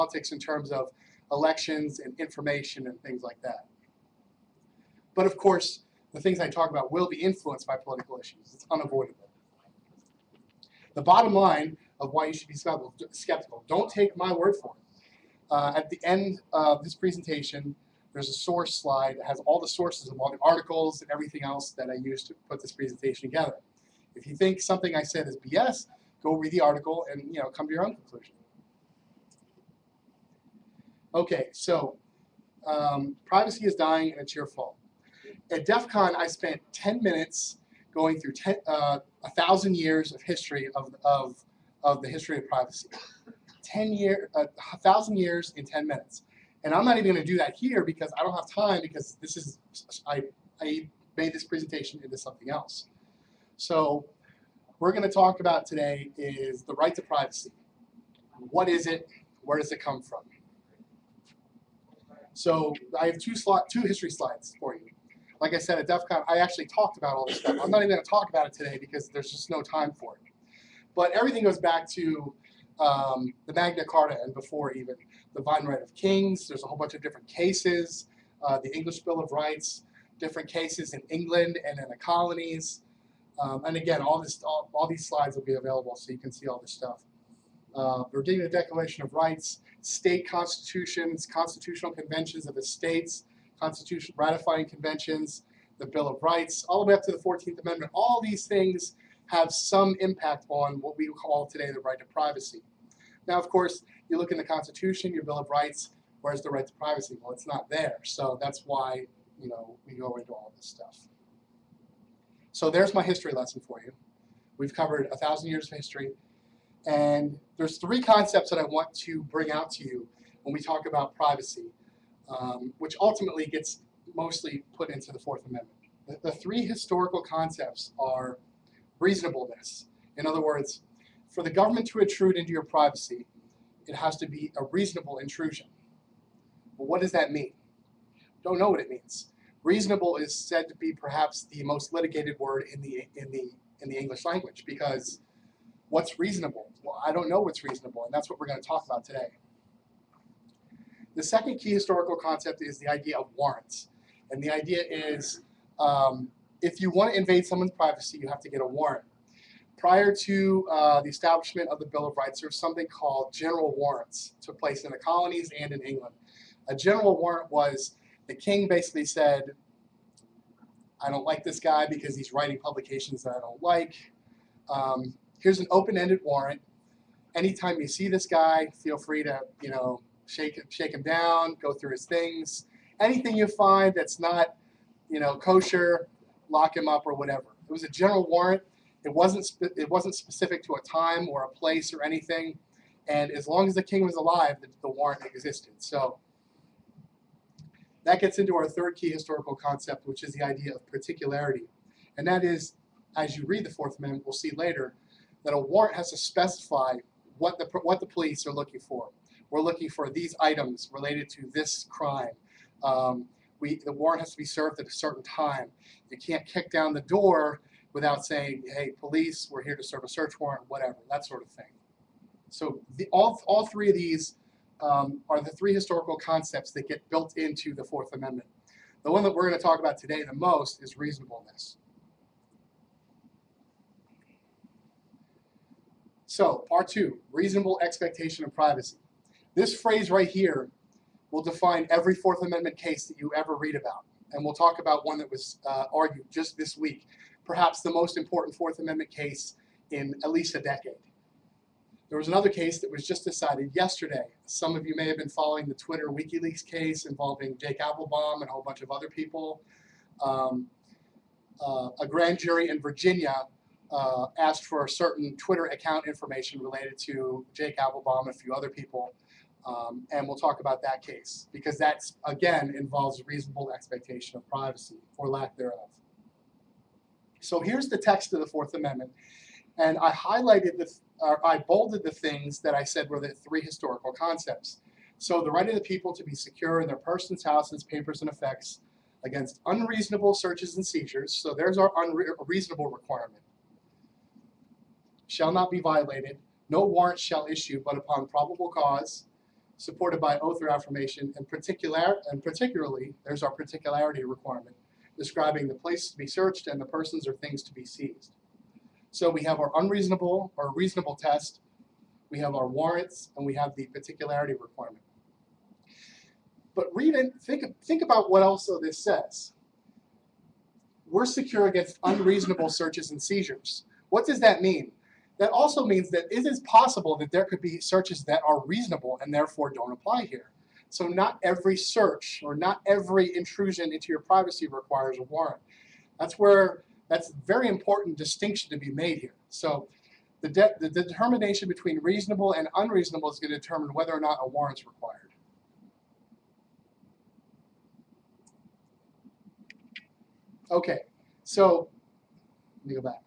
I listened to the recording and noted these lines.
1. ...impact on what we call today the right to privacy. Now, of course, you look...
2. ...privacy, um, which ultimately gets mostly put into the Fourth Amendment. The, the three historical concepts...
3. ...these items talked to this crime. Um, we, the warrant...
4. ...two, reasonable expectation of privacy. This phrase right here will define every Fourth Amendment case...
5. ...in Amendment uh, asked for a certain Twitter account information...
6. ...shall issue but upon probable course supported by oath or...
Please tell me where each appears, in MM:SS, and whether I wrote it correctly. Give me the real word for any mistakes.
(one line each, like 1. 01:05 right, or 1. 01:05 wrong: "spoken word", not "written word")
1. 01:40 right
2. 02:01 right
3. 03:30 wrong: "related", not "talked"
4. 03:56 right
5. 04:22 wrong: "Virginia", not "Amendment"
6. 04:57 wrong: "cause", not "course".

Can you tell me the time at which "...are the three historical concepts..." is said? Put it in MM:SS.
03:45.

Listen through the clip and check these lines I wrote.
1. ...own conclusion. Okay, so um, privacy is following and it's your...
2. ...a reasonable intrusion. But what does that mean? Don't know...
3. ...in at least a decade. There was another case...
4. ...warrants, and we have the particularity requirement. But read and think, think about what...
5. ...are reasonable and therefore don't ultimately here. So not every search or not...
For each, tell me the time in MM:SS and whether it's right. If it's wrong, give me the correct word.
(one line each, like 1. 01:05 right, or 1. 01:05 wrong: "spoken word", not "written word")
1. 00:27 wrong: "dying", not "following"
2. 02:14 right
3. 04:09 right
4. 05:12 right
5. 05:28 wrong: "apply", not "ultimately".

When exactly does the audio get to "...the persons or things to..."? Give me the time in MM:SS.
05:06.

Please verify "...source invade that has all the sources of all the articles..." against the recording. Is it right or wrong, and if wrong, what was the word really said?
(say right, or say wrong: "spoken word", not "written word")
wrong: "slide", not "invade".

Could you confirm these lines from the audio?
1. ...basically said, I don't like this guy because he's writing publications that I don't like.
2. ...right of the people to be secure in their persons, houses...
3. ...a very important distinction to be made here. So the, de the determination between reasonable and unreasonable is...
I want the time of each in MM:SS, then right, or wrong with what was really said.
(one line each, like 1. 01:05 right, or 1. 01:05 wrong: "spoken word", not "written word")
1. 02:48 right
2. 04:45 right
3. 05:37 right.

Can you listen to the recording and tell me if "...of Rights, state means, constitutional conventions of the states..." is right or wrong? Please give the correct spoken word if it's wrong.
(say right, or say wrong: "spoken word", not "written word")
wrong: "constitutions", not "means".